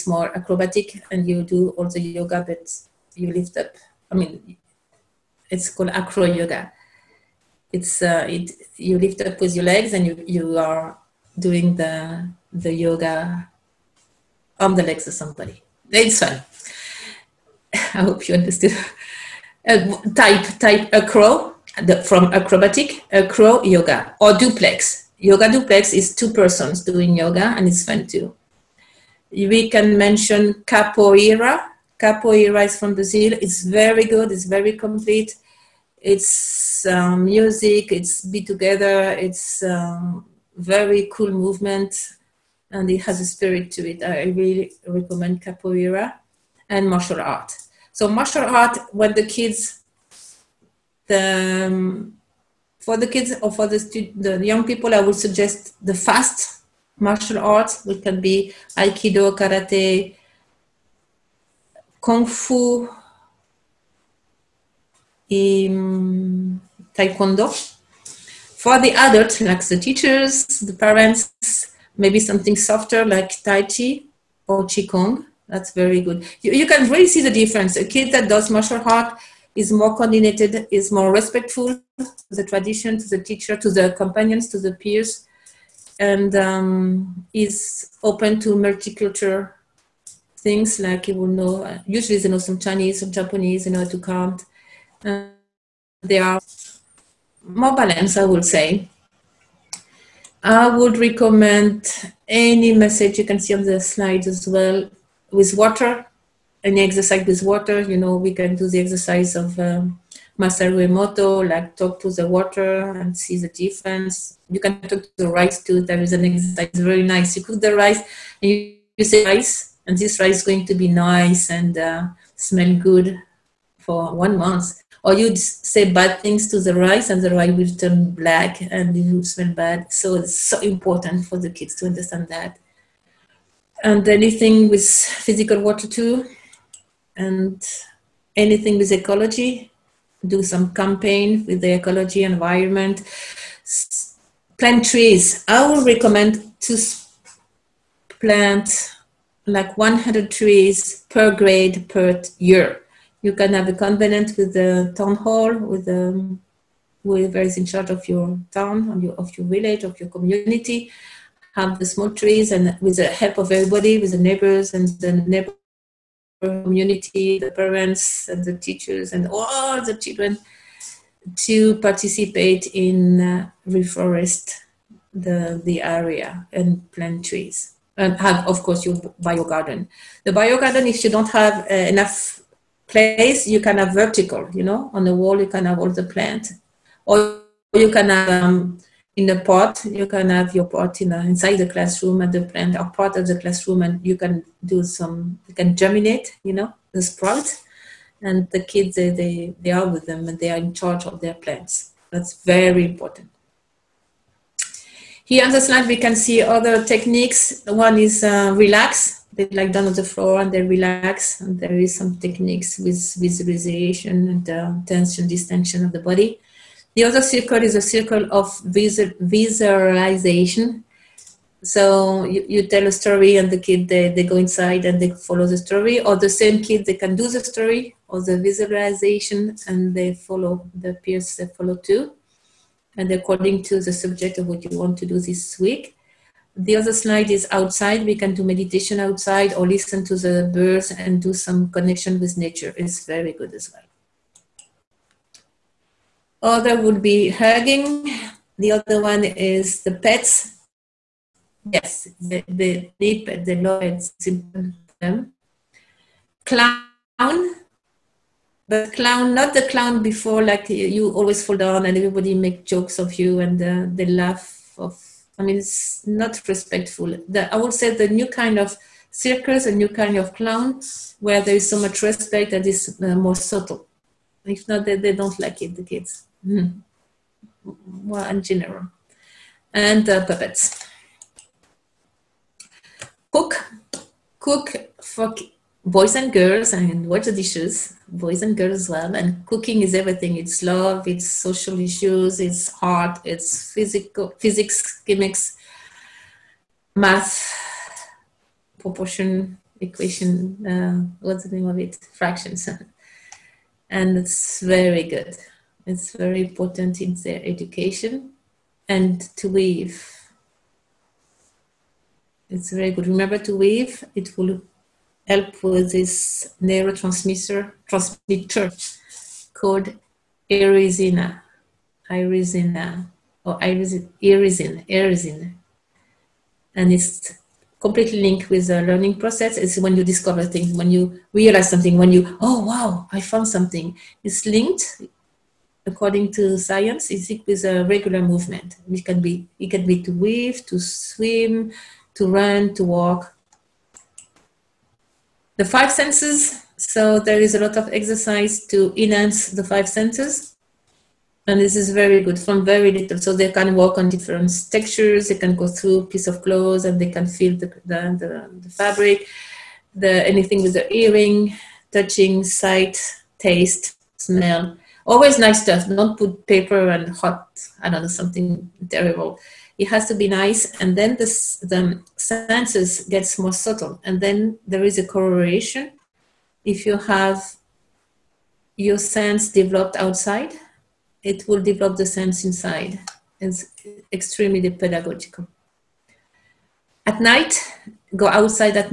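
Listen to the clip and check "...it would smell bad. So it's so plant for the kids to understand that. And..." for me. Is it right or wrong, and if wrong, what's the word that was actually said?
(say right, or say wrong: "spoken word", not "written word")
wrong: "important", not "plant".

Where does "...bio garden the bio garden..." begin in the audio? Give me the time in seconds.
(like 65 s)
179 s.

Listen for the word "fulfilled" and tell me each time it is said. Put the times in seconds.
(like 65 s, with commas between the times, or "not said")
not said.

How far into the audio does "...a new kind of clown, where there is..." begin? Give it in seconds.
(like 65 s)
269 s.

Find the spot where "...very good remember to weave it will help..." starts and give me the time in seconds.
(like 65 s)
312 s.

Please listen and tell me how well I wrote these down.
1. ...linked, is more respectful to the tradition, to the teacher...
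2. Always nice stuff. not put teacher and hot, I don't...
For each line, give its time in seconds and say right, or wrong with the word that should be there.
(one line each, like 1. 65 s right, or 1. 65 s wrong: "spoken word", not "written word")
1. 79 s wrong: "coordinated", not "linked"
2. 365 s wrong: "paper", not "teacher".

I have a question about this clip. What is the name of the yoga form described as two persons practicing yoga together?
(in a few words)
yoga duplex.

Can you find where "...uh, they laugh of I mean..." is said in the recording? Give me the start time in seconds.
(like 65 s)
263 s.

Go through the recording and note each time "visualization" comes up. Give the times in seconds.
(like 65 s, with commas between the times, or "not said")
213 s, 218 s, 228 s.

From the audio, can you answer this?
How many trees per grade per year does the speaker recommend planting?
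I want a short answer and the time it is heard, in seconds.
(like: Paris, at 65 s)
100, at 149 s.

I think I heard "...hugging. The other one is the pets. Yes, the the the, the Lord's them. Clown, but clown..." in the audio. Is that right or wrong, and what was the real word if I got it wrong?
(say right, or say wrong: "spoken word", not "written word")
right.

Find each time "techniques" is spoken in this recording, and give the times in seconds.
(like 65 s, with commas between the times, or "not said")
206 s, 212 s.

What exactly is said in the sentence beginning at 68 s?
For the adults, like the teachers, the parents, maybe something softer like Tai Chi or Qigong.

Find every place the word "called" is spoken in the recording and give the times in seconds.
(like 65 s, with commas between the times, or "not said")
5 s, 319 s.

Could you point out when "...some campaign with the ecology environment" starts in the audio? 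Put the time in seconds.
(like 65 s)
140 s.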